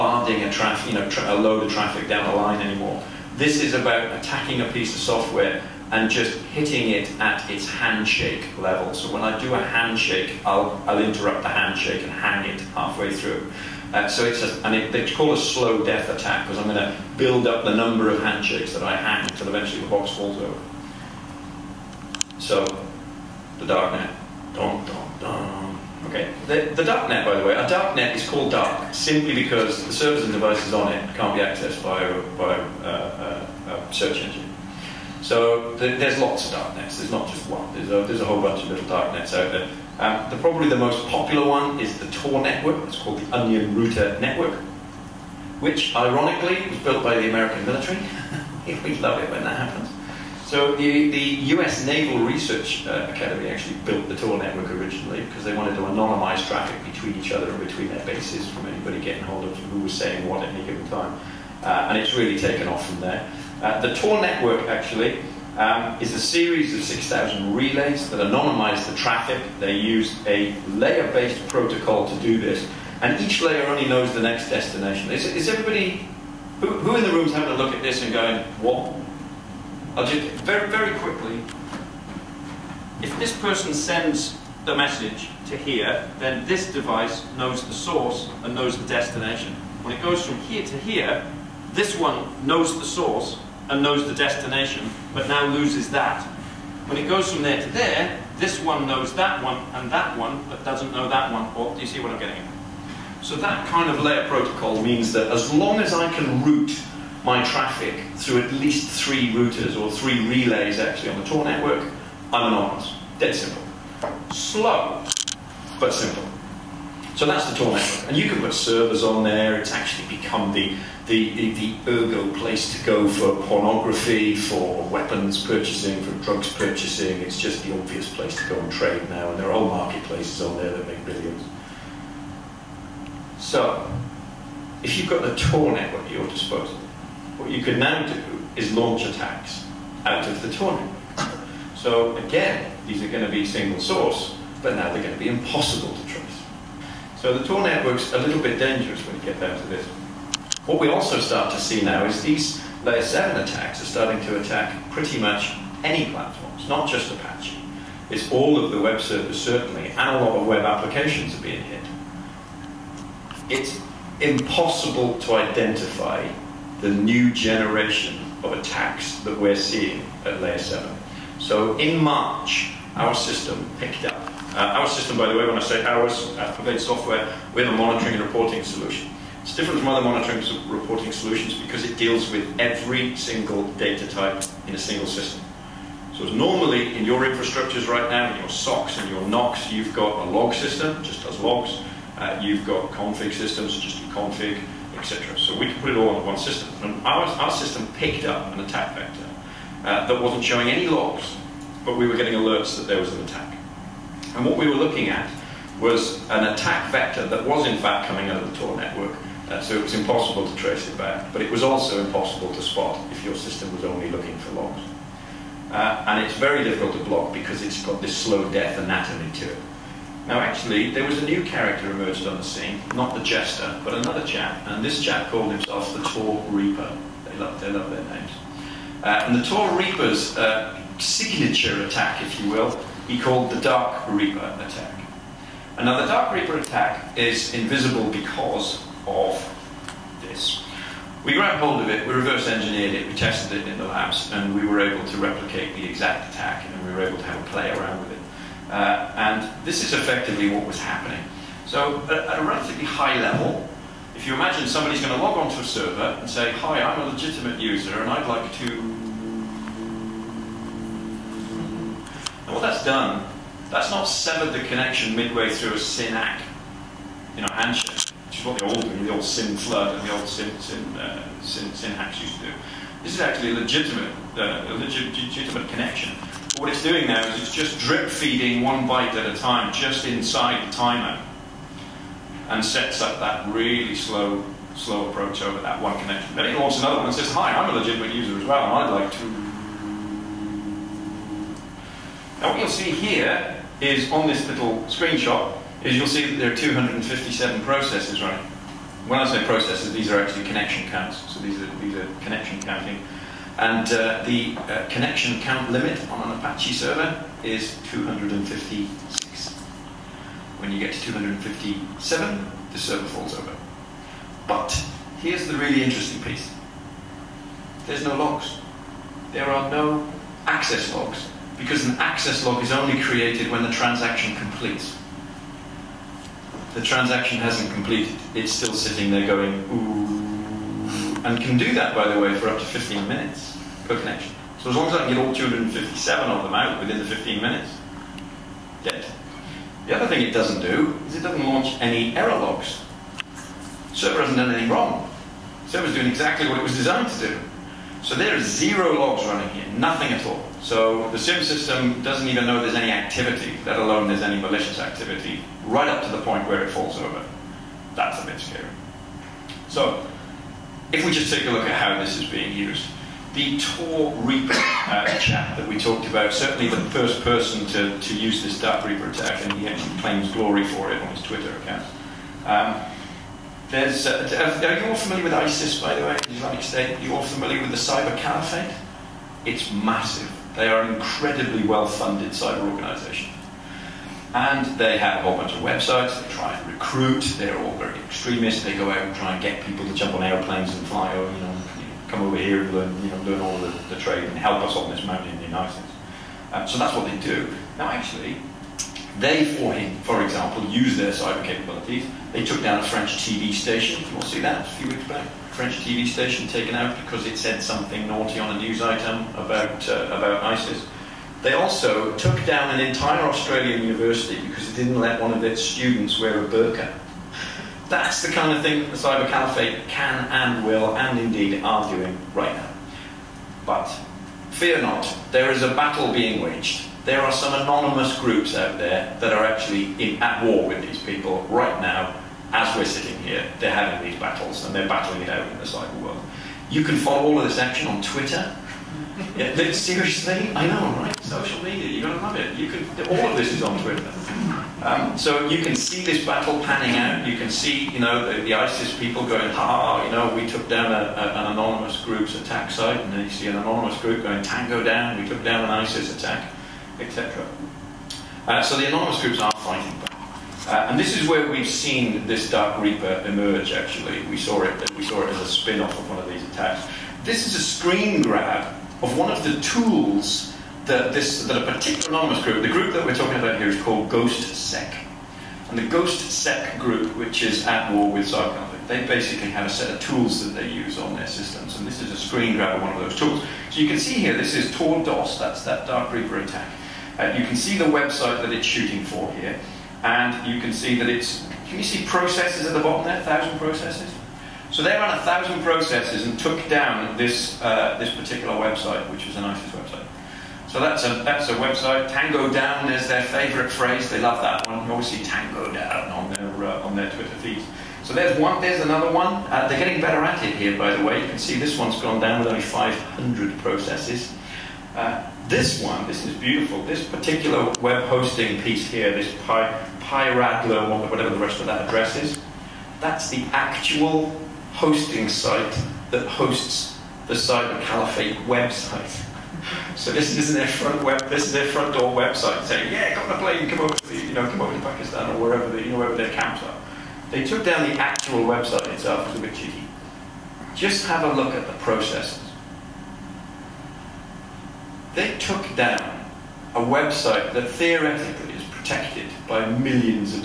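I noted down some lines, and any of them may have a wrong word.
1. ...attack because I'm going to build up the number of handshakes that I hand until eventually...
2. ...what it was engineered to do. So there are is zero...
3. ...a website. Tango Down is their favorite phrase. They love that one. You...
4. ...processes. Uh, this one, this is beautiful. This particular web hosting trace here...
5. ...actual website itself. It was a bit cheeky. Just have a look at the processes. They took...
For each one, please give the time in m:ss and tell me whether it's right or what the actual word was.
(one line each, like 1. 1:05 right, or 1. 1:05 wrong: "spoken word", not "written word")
1. 0:16 right
2. 5:46 wrong: "designed", not "engineered"
3. 8:21 right
4. 8:33 wrong: "piece", not "trace"
5. 8:57 right.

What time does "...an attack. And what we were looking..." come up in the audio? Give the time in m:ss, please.
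3:23.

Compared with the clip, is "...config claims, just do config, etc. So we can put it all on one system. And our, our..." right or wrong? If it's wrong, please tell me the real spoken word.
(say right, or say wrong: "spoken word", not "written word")
wrong: "systems", not "claims".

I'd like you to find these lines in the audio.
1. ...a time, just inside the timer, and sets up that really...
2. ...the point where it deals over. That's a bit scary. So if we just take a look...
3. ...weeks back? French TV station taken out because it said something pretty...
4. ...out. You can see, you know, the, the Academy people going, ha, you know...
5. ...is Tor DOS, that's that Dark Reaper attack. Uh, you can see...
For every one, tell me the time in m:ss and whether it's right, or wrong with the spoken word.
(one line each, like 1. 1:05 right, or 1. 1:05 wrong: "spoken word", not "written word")
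1. 4:39 right
2. 5:56 wrong: "falls", not "deals"
3. 6:44 wrong: "naughty", not "pretty"
4. 7:26 wrong: "ISIS", not "Academy"
5. 8:04 right.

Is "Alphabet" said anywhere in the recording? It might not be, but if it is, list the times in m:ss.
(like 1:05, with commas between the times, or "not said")
2:56.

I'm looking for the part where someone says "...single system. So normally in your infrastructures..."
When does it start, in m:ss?
3:04.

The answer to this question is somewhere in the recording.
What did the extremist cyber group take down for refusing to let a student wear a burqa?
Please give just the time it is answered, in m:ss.
6:53.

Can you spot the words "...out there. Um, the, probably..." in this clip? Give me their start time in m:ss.
0:39.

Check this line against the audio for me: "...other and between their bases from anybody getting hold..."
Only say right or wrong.
right.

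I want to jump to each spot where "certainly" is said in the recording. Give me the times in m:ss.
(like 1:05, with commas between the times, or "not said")
2:39, 6:06.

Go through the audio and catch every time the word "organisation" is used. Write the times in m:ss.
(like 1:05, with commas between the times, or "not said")
6:22.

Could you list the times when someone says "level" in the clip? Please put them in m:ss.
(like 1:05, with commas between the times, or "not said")
0:08, 4:13.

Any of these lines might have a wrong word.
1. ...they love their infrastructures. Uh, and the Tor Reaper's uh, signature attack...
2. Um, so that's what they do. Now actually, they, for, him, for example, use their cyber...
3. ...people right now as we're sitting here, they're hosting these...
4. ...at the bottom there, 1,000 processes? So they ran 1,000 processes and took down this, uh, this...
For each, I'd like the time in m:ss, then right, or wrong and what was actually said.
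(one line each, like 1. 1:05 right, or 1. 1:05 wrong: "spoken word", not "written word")
1. 3:47 wrong: "names", not "infrastructures"
2. 6:36 right
3. 7:11 wrong: "having", not "hosting"
4. 8:12 right.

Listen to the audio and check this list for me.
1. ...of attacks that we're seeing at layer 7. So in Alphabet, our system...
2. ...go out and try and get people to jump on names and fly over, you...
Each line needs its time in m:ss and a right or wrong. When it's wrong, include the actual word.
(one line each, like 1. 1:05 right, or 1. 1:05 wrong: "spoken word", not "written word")
1. 2:48 wrong: "March", not "Alphabet"
2. 6:28 wrong: "airplanes", not "names".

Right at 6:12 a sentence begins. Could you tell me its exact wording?
Um, there's, uh, are you all familiar with ISIS, by the way, the Islamic State?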